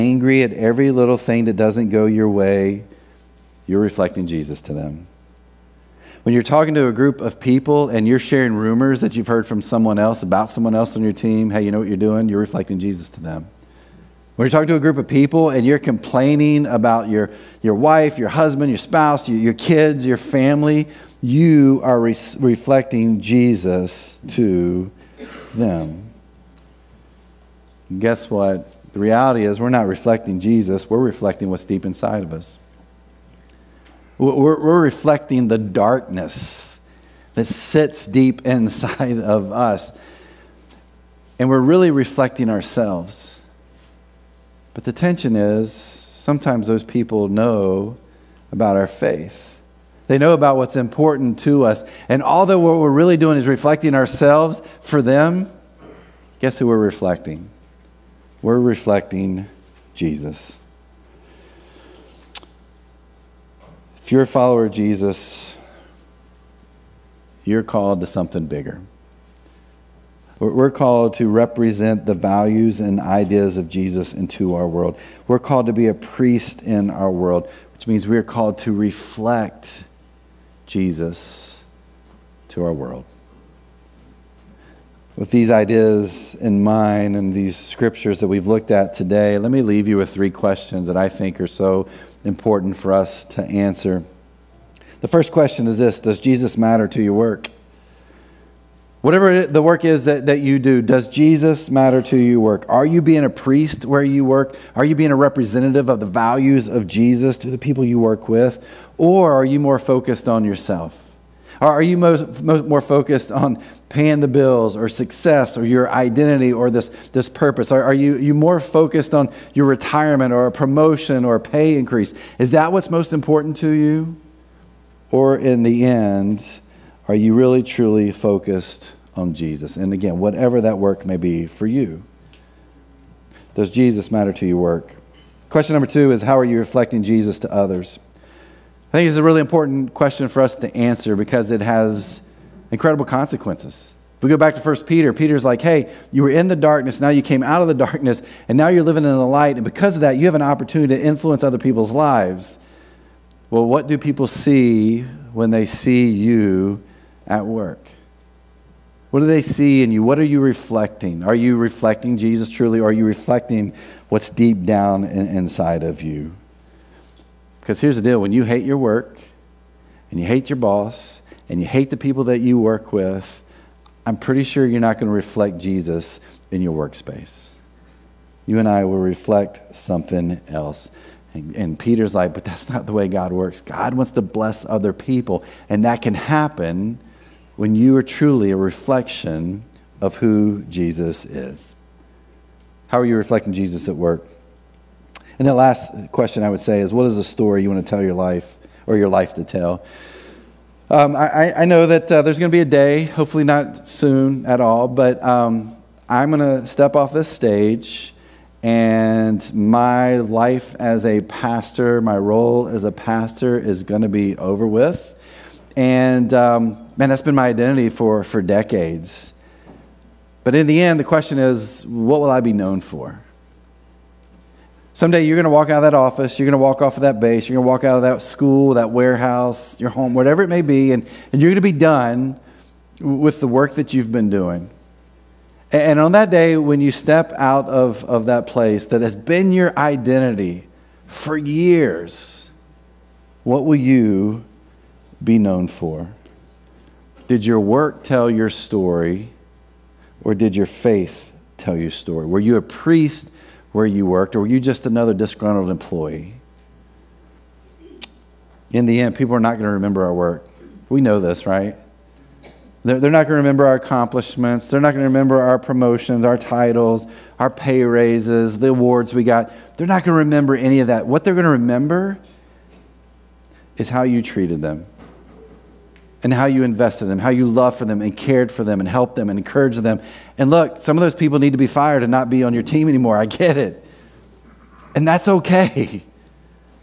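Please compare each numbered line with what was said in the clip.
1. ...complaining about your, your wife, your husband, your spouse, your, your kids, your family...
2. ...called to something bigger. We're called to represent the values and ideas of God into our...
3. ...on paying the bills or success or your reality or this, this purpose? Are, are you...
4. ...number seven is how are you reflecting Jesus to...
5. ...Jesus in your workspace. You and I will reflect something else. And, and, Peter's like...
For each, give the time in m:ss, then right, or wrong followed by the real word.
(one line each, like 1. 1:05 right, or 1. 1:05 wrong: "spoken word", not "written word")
1. 0:15 right
2. 1:07 wrong: "Jesus", not "God"
3. 1:53 wrong: "identity", not "reality"
4. 2:15 wrong: "two", not "seven"
5. 2:55 right.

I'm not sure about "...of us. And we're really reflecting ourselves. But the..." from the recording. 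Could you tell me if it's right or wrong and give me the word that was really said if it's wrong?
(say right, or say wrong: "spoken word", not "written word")
right.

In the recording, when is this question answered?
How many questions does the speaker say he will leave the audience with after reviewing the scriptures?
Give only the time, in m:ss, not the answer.
1:30.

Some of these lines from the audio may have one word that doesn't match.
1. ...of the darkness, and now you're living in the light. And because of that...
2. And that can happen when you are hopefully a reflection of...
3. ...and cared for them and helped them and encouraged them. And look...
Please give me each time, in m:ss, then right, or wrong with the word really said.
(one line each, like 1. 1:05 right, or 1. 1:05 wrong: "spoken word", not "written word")
1. 2:27 right
2. 3:05 wrong: "truly", not "hopefully"
3. 4:38 right.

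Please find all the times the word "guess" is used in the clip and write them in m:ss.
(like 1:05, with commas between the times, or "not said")
0:27, 0:56.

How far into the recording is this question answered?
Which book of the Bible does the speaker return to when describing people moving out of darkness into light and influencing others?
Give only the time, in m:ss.
2:24.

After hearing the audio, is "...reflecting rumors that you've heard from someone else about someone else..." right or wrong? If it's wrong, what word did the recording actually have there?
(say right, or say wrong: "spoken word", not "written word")
wrong: "sharing", not "reflecting".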